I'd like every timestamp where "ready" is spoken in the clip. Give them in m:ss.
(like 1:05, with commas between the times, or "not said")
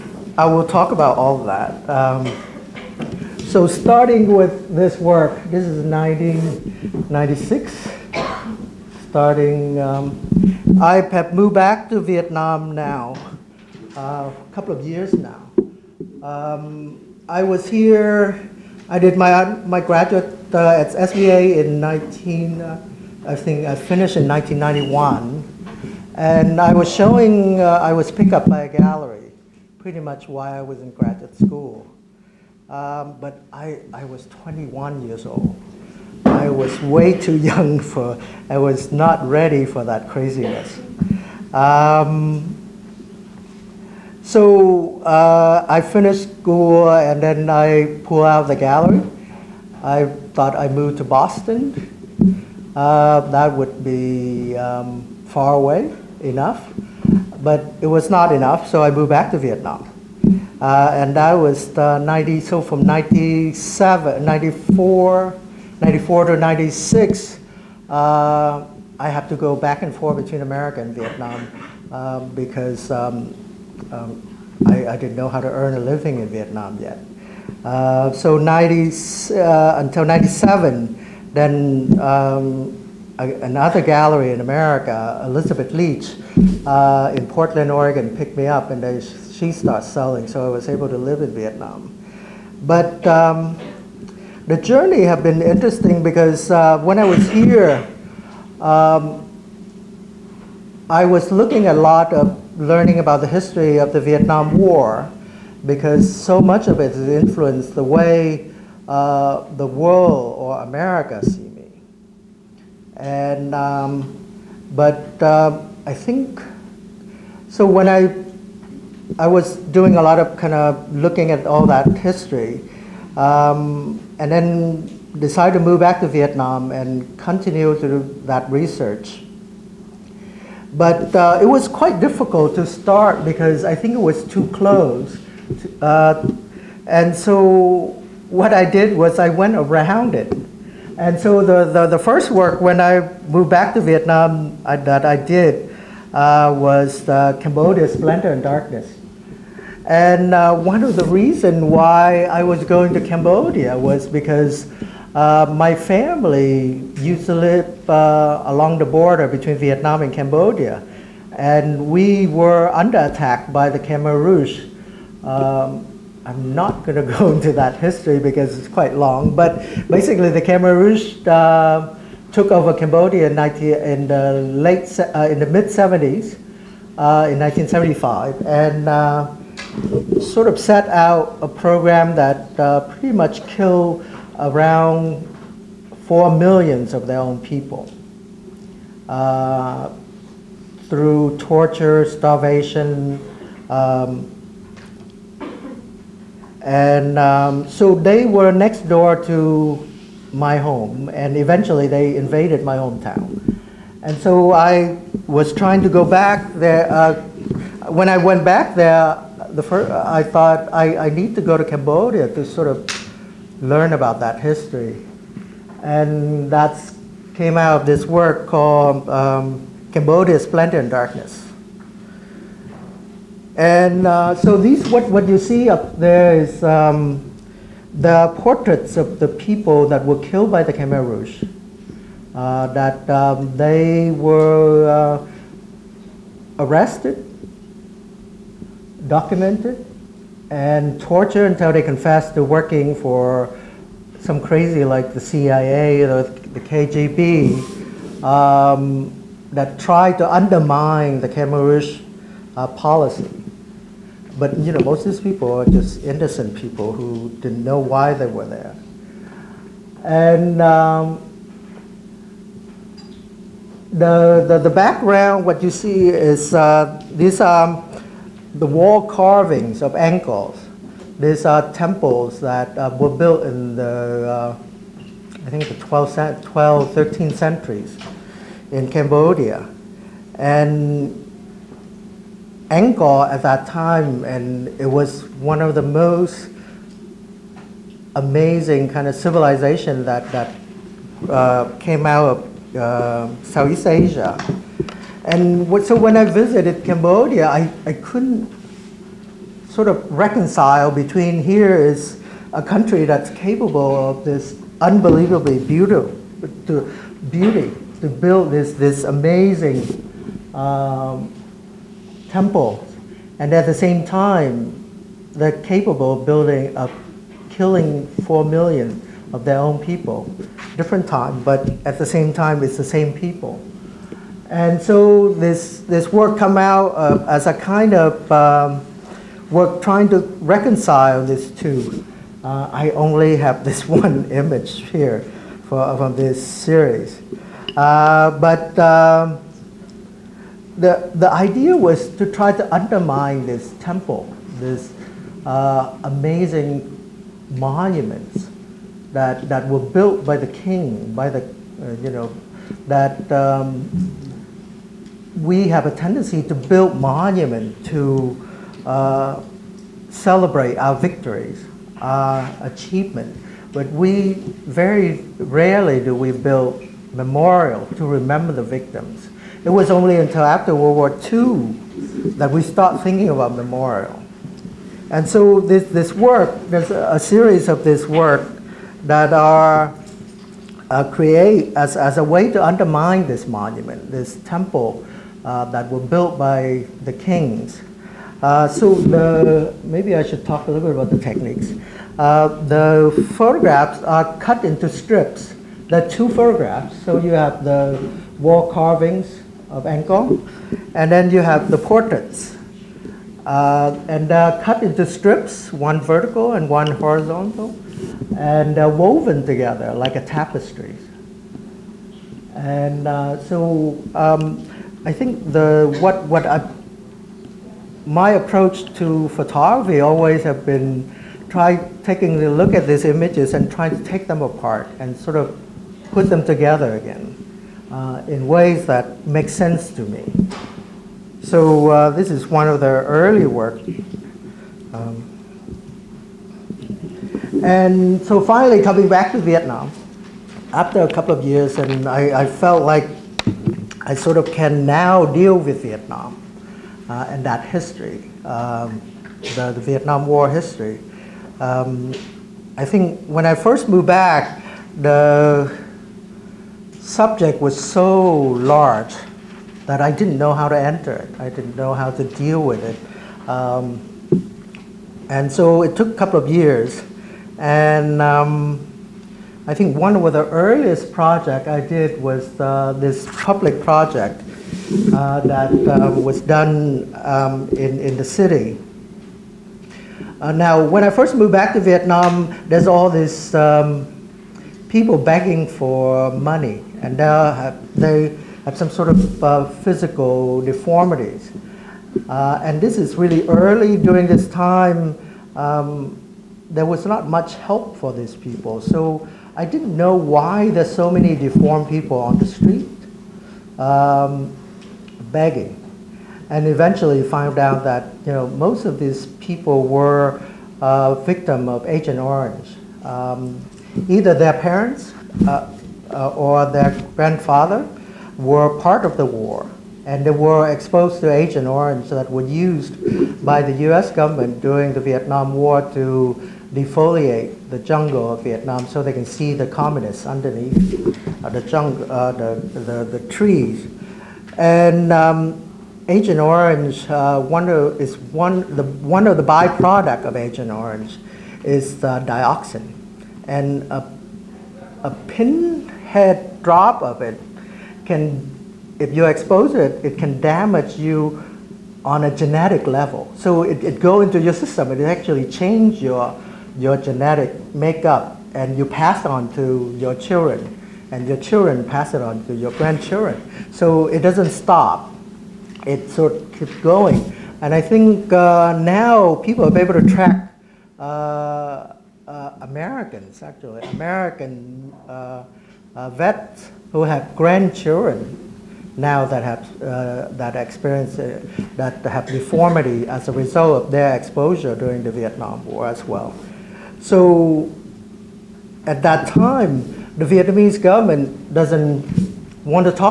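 0:39.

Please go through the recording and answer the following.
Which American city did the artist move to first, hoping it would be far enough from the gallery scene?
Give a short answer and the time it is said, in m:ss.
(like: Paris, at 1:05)
Boston, at 0:51.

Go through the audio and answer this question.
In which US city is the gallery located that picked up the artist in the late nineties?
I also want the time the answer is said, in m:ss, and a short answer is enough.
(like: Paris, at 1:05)
Portland, Oregon, at 1:27.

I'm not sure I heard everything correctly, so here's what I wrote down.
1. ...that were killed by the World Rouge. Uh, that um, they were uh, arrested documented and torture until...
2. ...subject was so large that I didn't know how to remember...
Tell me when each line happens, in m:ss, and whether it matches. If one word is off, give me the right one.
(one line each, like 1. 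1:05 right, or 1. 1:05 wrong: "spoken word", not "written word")
1. 3:49 wrong: "Khmer", not "World"
2. 7:36 wrong: "enter", not "remember".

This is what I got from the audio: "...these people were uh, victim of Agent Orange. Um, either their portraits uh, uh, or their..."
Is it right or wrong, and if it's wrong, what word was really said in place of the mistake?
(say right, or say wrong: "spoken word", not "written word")
wrong: "parents", not "portraits".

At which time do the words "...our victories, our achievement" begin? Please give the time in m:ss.
6:00.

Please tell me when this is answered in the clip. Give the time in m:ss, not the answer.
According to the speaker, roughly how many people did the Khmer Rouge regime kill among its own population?
3:06.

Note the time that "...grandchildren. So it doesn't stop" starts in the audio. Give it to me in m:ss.
9:22.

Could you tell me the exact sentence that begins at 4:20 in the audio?
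And um, the, the, the, background, what you see is uh, these are the wall carvings of Angkor.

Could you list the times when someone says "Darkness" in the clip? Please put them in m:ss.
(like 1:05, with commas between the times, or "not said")
2:28, 3:40.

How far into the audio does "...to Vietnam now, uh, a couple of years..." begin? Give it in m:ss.
0:11.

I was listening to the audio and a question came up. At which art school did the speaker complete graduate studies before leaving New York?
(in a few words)
SVA.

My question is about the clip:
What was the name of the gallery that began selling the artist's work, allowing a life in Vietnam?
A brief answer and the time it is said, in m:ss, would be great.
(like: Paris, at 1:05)
Elizabeth Leach, at 1:25.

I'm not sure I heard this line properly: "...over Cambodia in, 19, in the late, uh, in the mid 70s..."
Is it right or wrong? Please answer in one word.
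right.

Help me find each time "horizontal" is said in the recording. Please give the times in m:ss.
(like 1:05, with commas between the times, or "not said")
6:46.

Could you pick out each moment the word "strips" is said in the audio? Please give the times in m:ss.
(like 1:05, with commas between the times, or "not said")
6:34, 6:45.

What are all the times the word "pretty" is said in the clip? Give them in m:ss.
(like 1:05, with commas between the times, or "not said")
0:29, 3:02.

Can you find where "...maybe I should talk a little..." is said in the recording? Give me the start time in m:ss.
6:29.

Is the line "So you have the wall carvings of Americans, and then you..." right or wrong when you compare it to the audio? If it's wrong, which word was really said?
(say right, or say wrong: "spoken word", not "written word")
wrong: "Angkor", not "Americans".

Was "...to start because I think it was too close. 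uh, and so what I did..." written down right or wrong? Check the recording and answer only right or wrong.
right.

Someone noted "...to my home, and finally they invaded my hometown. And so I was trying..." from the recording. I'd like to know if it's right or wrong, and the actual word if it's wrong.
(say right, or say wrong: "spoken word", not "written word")
wrong: "eventually", not "finally".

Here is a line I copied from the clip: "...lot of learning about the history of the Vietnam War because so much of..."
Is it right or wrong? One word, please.
right.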